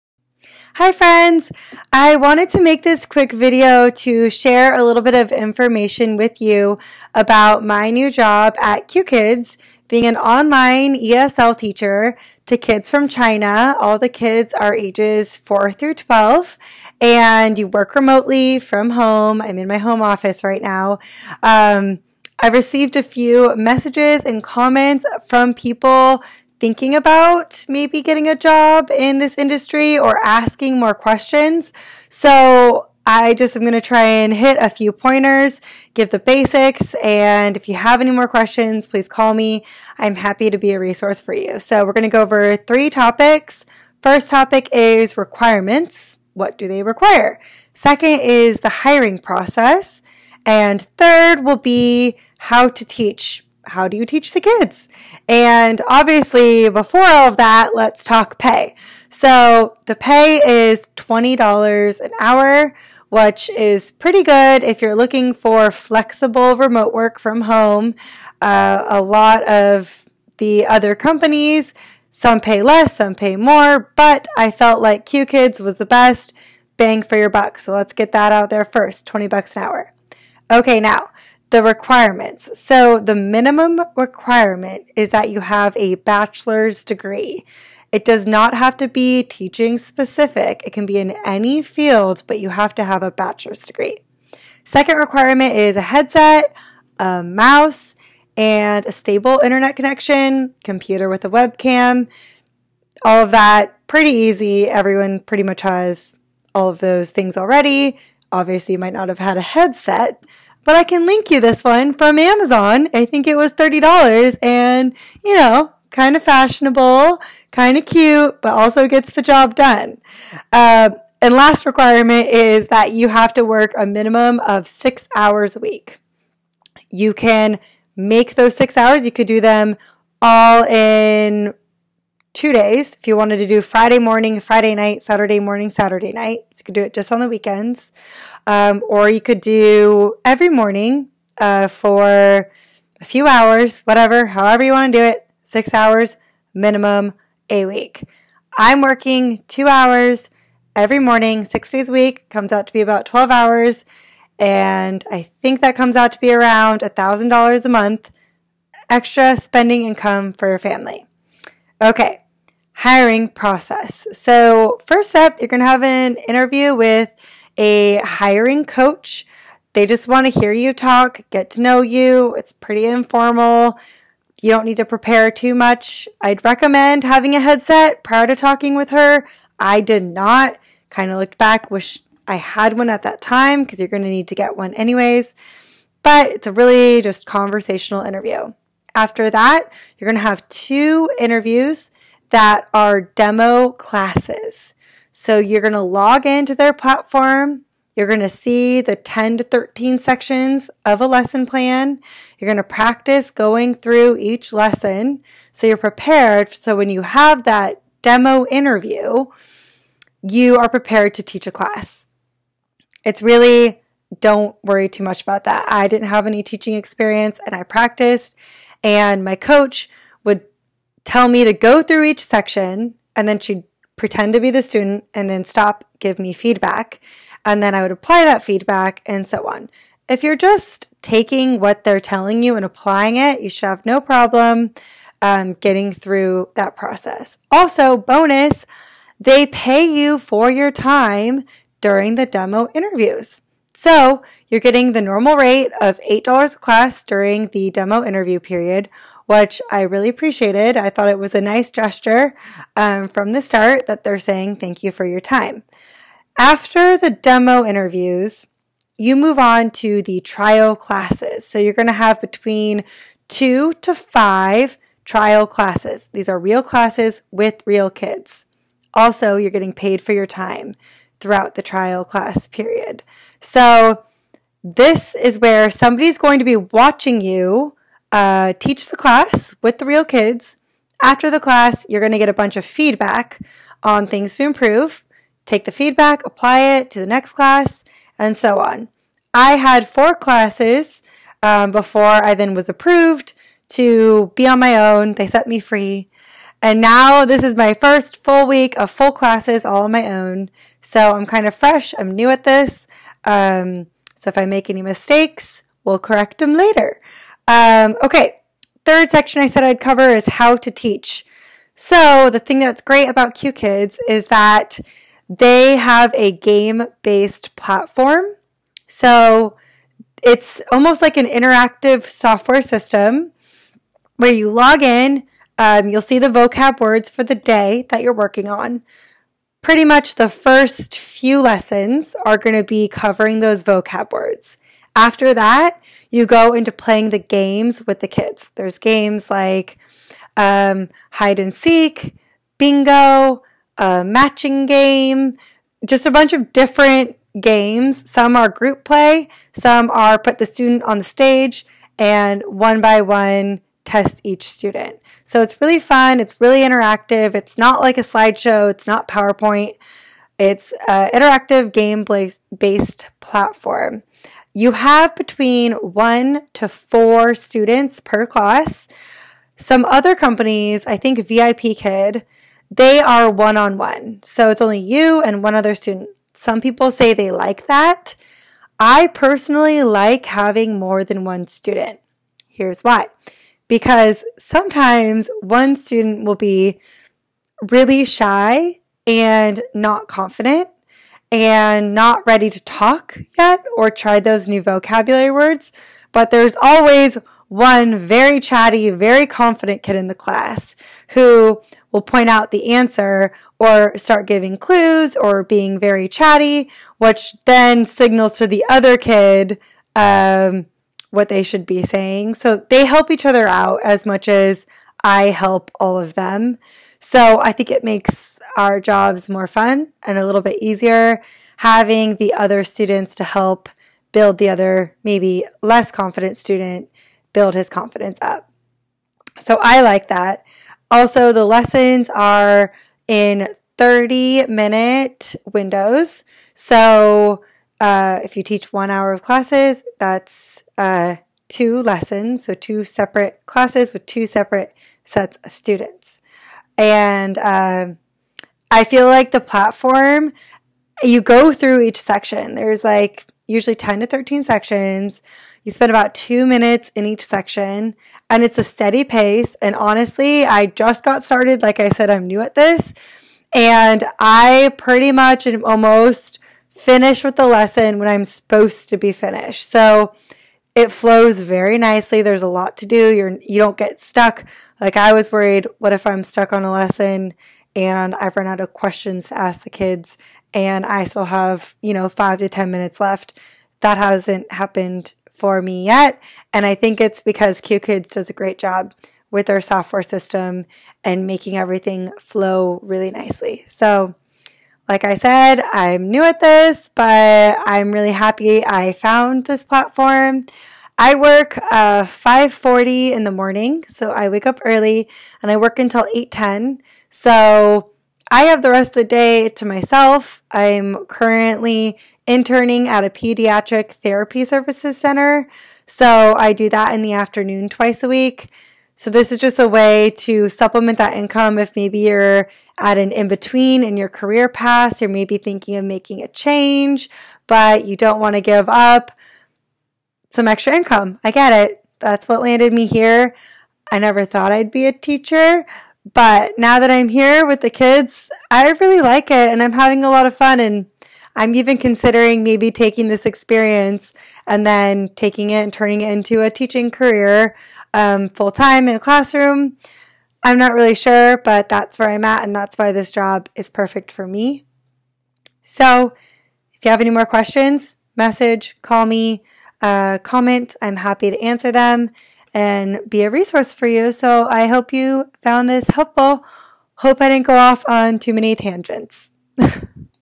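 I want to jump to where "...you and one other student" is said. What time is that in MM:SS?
06:14.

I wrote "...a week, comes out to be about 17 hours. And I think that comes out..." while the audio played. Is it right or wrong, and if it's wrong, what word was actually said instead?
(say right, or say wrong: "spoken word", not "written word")
wrong: "12", not "17".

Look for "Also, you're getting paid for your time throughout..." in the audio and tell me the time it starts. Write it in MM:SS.
04:28.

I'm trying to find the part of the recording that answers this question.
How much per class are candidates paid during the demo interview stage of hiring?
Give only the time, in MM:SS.
04:06.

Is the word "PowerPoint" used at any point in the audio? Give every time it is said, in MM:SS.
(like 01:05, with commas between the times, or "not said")
05:59.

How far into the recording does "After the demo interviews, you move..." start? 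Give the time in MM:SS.
04:16.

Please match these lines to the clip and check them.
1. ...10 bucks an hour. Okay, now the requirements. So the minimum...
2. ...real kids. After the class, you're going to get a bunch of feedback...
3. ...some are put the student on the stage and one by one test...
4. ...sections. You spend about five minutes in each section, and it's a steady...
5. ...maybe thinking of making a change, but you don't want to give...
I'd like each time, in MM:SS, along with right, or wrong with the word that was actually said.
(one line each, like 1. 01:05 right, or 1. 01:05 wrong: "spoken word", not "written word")
1. 01:19 wrong: "20", not "10"
2. 04:39 right
3. 05:49 right
4. 07:34 wrong: "two", not "five"
5. 08:45 right.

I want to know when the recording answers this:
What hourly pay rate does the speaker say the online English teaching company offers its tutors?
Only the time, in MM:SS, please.
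01:00.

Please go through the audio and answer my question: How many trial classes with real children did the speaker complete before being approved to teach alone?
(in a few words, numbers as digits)
4.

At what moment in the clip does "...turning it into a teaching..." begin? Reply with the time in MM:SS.
09:05.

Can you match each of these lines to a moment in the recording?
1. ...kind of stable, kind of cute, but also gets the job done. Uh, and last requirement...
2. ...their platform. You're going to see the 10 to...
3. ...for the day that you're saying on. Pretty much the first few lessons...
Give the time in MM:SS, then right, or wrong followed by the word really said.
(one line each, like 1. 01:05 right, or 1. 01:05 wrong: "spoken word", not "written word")
1. 01:55 wrong: "fashionable", not "stable"
2. 03:16 right
3. 05:27 wrong: "working", not "saying".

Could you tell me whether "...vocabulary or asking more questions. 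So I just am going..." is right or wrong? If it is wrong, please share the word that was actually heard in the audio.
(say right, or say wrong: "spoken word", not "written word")
wrong: "industry", not "vocabulary".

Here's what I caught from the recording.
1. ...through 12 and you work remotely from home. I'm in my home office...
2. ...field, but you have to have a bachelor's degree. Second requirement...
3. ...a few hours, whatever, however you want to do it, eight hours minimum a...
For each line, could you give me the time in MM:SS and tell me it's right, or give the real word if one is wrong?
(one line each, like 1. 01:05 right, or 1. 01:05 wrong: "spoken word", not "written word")
1. 00:15 right
2. 01:31 right
3. 02:22 wrong: "six", not "eight".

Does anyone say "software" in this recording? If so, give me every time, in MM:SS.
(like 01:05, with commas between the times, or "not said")
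05:22, 08:09.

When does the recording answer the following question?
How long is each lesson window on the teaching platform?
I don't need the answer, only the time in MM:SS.
07:13.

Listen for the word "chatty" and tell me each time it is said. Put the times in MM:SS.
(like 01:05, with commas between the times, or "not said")
06:38, 06:46.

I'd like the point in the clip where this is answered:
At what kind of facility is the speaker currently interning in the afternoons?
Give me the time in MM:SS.
08:33.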